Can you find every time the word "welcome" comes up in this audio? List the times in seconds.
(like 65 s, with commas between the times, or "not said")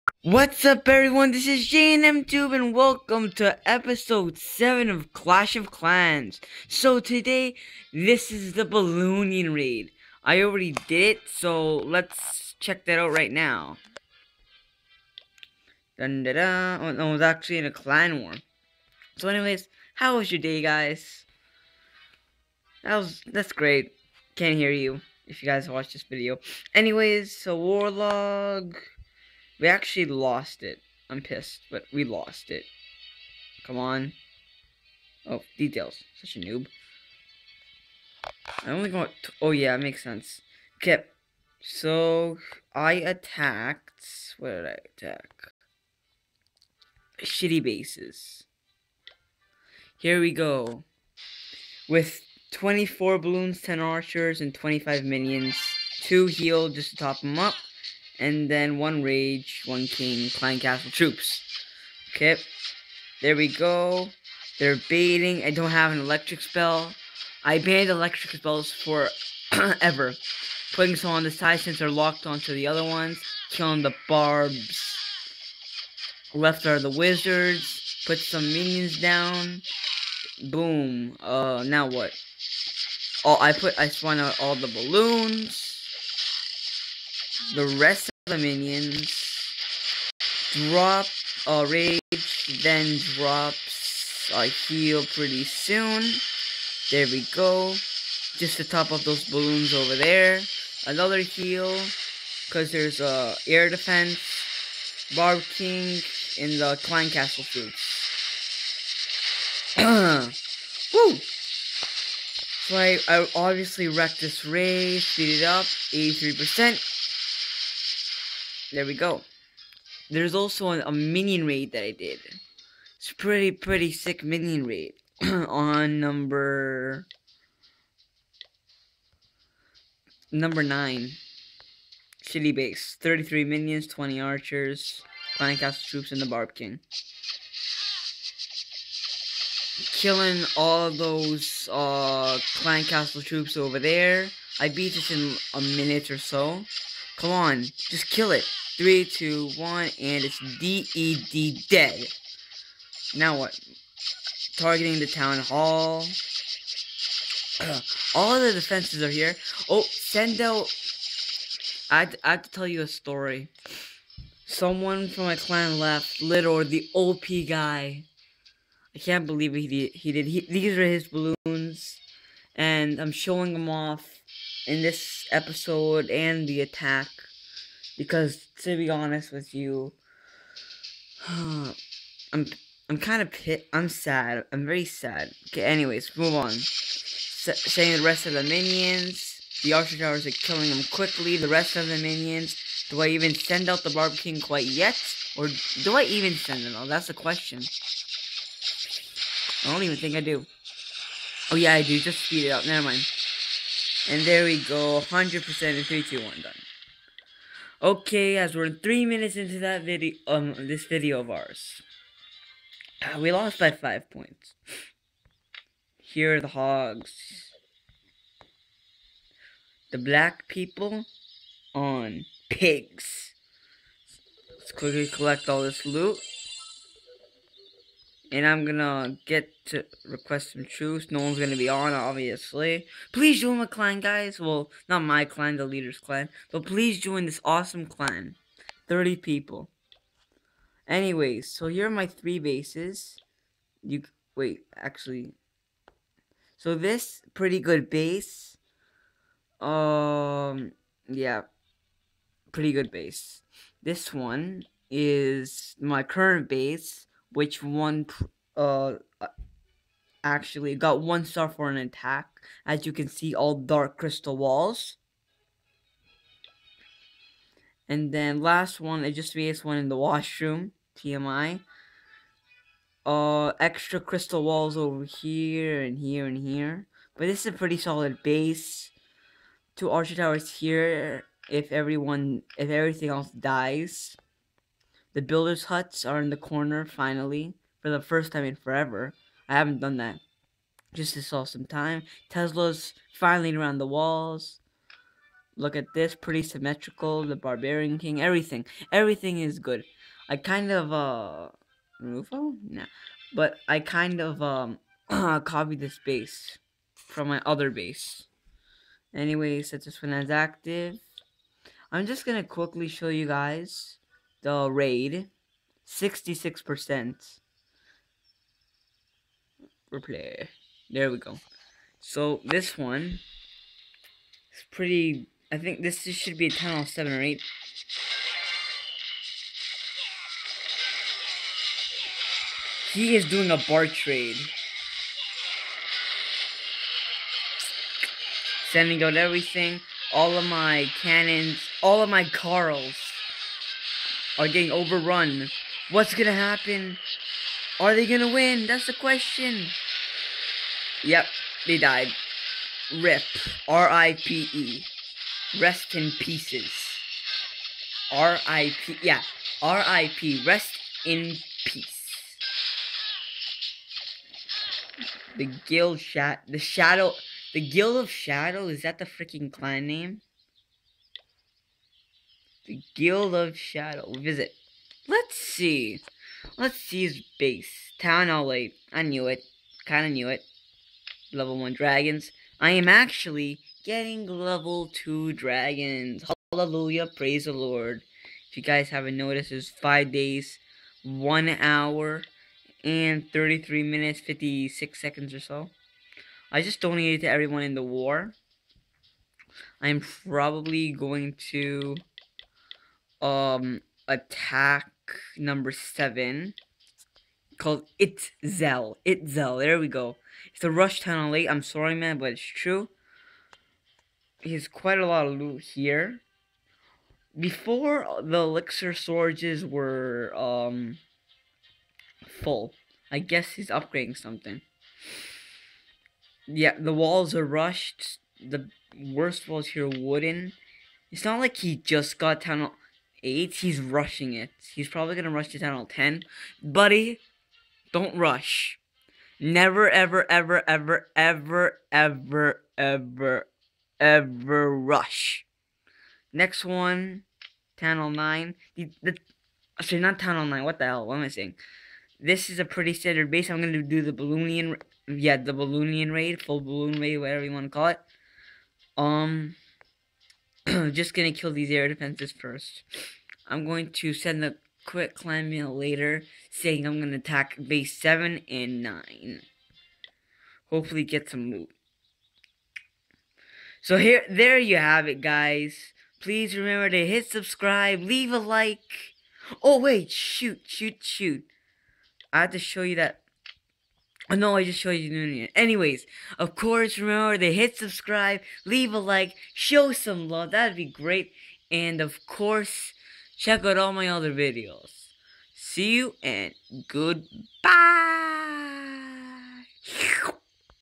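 2 s.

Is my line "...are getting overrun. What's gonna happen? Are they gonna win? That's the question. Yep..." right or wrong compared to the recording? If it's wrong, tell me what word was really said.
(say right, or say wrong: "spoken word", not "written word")
right.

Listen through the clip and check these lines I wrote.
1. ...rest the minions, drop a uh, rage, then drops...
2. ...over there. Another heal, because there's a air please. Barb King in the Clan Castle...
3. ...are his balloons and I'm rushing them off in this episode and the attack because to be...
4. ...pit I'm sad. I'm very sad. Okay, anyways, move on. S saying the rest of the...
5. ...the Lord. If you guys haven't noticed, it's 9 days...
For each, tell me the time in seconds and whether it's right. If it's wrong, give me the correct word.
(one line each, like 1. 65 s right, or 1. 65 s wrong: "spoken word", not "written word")
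1. 87 s right
2. 99 s wrong: "defense", not "please"
3. 170 s wrong: "showing", not "rushing"
4. 183 s right
5. 387 s wrong: "5", not "9".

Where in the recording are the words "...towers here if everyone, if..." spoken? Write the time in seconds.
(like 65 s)
280 s.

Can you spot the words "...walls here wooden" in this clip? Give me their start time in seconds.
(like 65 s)
429 s.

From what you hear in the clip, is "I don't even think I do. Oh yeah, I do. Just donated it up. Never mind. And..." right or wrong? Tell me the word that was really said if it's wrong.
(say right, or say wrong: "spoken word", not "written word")
wrong: "speed", not "donated".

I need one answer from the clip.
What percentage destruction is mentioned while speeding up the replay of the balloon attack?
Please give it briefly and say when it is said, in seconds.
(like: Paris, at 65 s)
83%, at 115 s.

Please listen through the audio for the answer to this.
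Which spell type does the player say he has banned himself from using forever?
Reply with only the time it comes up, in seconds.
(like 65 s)
67 s.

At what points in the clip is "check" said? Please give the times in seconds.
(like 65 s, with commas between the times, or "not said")
12 s, 493 s.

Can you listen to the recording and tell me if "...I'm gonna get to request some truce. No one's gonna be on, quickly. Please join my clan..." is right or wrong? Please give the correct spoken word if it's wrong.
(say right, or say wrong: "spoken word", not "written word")
wrong: "obviously", not "quickly".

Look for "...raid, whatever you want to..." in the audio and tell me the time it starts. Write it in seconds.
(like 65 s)
457 s.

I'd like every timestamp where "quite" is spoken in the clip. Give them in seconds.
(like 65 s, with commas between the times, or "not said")
194 s, 414 s.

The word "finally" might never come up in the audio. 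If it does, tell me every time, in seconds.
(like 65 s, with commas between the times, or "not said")
286 s, 293 s.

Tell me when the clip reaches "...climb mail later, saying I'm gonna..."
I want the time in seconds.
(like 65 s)
465 s.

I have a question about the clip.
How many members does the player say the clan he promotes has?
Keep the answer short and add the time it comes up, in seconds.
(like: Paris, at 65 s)
30, at 238 s.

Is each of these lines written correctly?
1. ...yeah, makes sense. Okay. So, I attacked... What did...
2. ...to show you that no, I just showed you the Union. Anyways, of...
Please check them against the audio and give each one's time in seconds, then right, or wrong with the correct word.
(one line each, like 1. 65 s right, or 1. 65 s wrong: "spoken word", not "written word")
1. 39 s right
2. 482 s right.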